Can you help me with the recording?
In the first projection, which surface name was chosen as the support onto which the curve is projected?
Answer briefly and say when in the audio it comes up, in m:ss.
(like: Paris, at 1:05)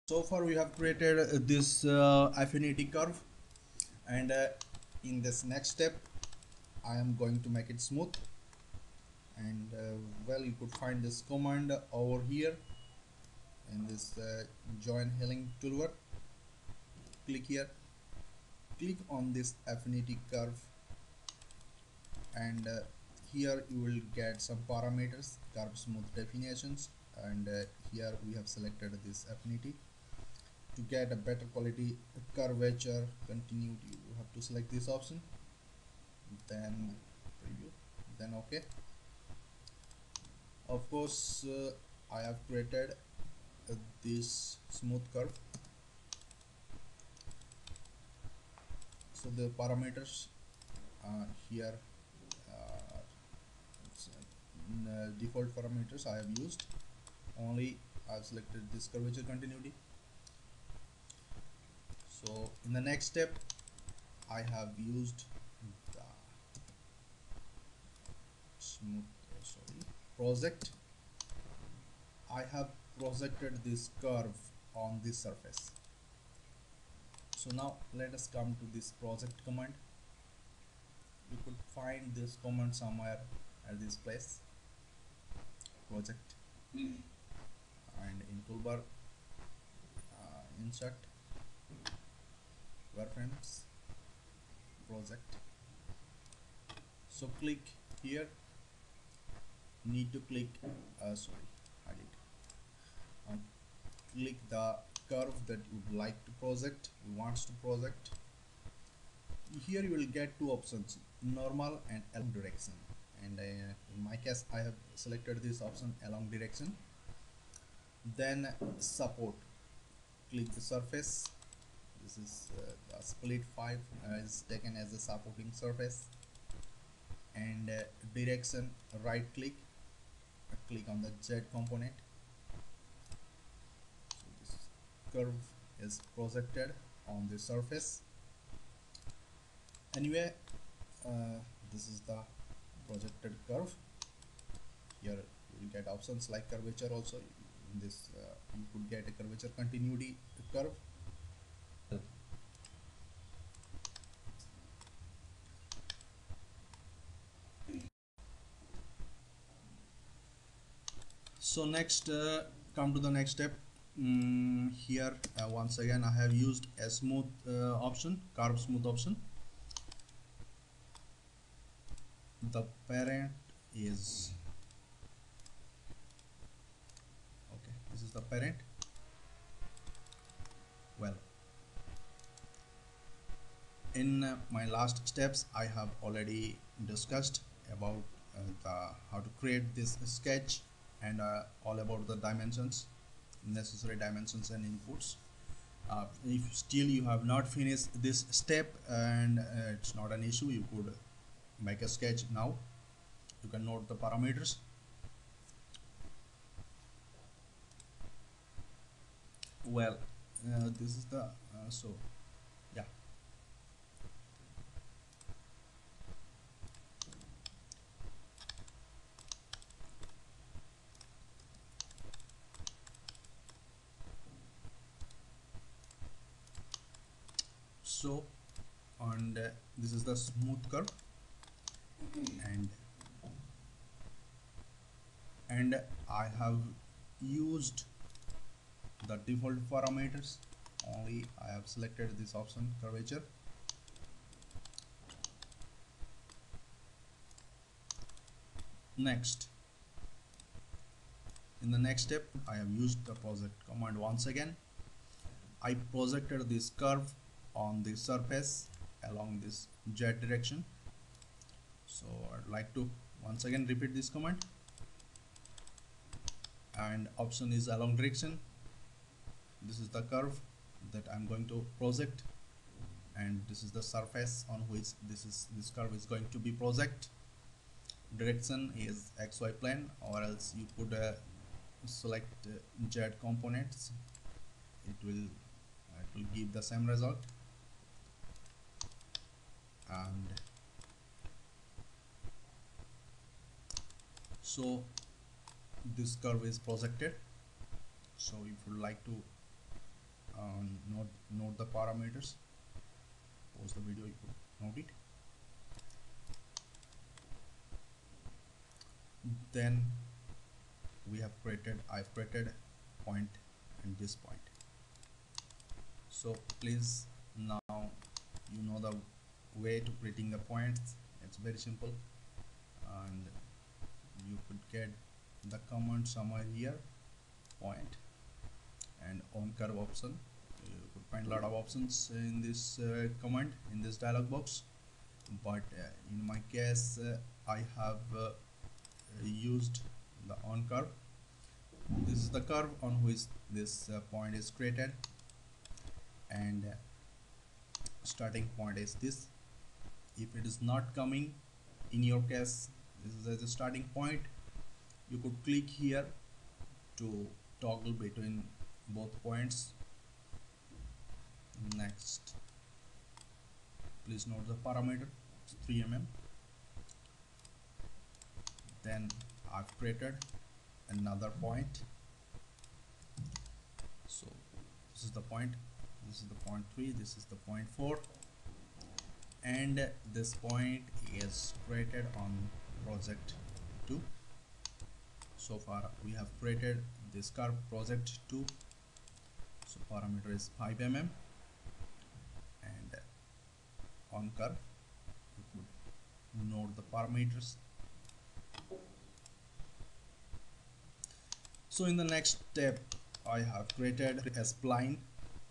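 split 5, at 2:03.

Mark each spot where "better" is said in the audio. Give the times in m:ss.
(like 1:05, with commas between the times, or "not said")
0:31.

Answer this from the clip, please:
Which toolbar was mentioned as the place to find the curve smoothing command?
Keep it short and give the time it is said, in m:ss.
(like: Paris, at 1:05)
join healing toolbar, at 0:14.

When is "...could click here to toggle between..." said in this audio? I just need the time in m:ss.
5:55.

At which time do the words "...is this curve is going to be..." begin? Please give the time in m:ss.
4:35.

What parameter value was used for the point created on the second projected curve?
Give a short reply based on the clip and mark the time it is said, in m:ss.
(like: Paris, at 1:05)
5 mm, at 6:30.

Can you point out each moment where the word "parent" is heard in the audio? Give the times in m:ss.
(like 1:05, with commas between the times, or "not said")
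2:52, 2:58.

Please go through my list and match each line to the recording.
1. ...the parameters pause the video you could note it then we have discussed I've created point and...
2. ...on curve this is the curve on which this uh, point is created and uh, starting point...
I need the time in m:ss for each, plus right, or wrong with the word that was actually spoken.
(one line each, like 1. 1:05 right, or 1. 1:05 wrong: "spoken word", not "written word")
1. 5:01 wrong: "created", not "discussed"
2. 5:40 right.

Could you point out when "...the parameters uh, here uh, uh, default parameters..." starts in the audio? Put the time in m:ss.
0:49.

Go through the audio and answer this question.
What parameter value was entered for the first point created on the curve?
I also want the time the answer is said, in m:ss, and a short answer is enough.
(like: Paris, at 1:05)
3 mm, at 6:05.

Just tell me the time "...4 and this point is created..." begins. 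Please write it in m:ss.
6:17.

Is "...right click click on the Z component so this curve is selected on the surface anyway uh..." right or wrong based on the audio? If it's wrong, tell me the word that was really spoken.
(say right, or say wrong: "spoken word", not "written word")
wrong: "projected", not "selected".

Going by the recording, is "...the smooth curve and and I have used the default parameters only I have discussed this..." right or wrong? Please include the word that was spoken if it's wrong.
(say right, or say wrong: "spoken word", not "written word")
wrong: "selected", not "discussed".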